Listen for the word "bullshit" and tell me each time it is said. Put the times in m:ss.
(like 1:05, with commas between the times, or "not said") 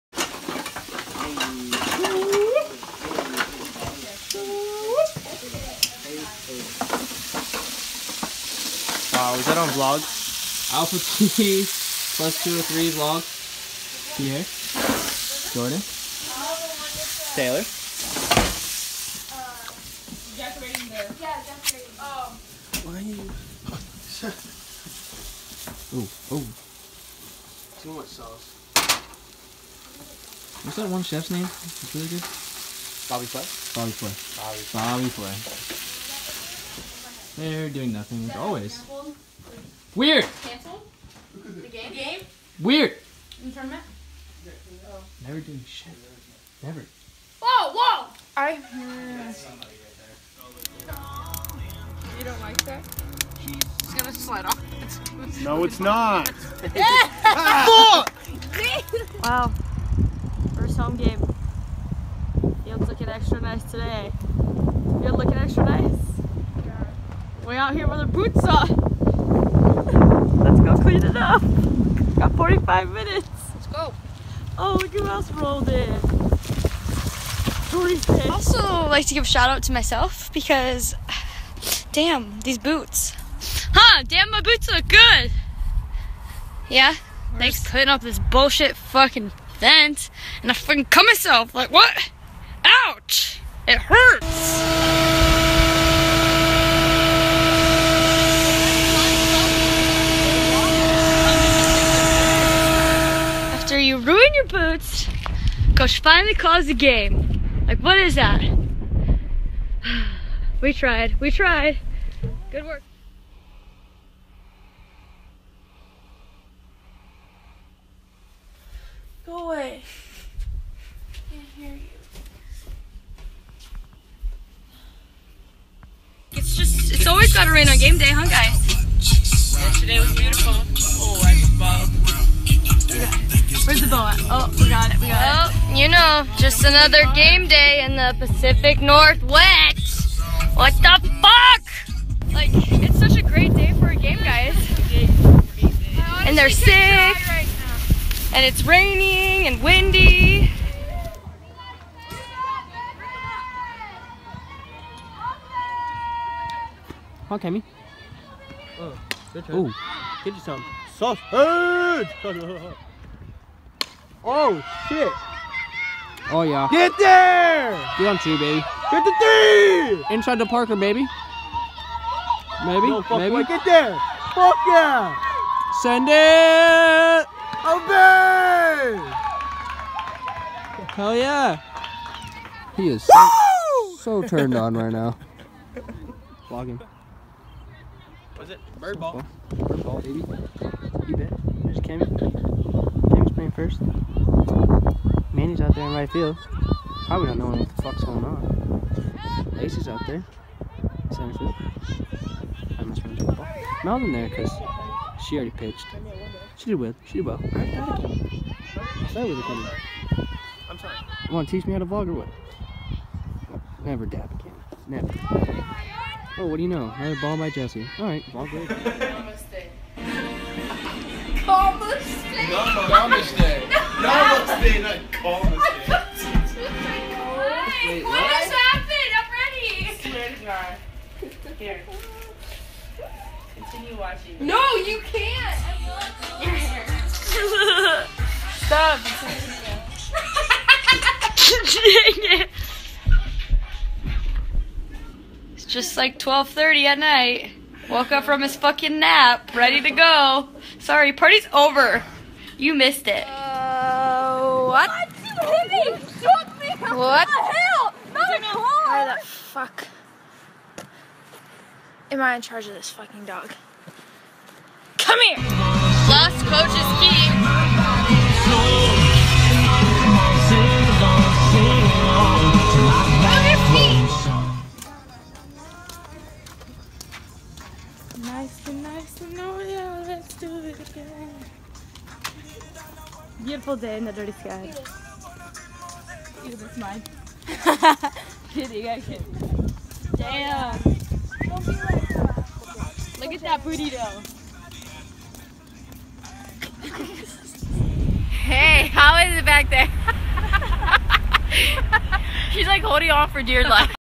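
1:28.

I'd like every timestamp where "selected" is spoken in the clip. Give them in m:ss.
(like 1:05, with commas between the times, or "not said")
not said.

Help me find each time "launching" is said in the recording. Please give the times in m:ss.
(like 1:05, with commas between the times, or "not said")
not said.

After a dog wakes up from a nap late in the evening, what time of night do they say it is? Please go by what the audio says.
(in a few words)
12:30.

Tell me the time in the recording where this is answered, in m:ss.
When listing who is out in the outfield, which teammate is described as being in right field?
3:15.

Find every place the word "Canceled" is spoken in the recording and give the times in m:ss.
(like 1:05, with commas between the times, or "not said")
0:40.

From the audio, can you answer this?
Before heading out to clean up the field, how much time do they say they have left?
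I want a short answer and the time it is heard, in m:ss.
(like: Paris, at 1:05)
45 minutes, at 1:12.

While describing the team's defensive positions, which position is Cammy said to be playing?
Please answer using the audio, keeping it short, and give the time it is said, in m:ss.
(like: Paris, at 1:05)
First, at 3:13.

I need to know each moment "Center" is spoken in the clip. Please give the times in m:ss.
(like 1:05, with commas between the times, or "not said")
3:21.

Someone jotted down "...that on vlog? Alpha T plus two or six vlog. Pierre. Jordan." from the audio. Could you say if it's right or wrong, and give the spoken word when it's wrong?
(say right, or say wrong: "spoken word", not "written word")
wrong: "three", not "six".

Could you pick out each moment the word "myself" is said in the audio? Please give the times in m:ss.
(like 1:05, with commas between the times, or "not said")
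1:19, 1:31.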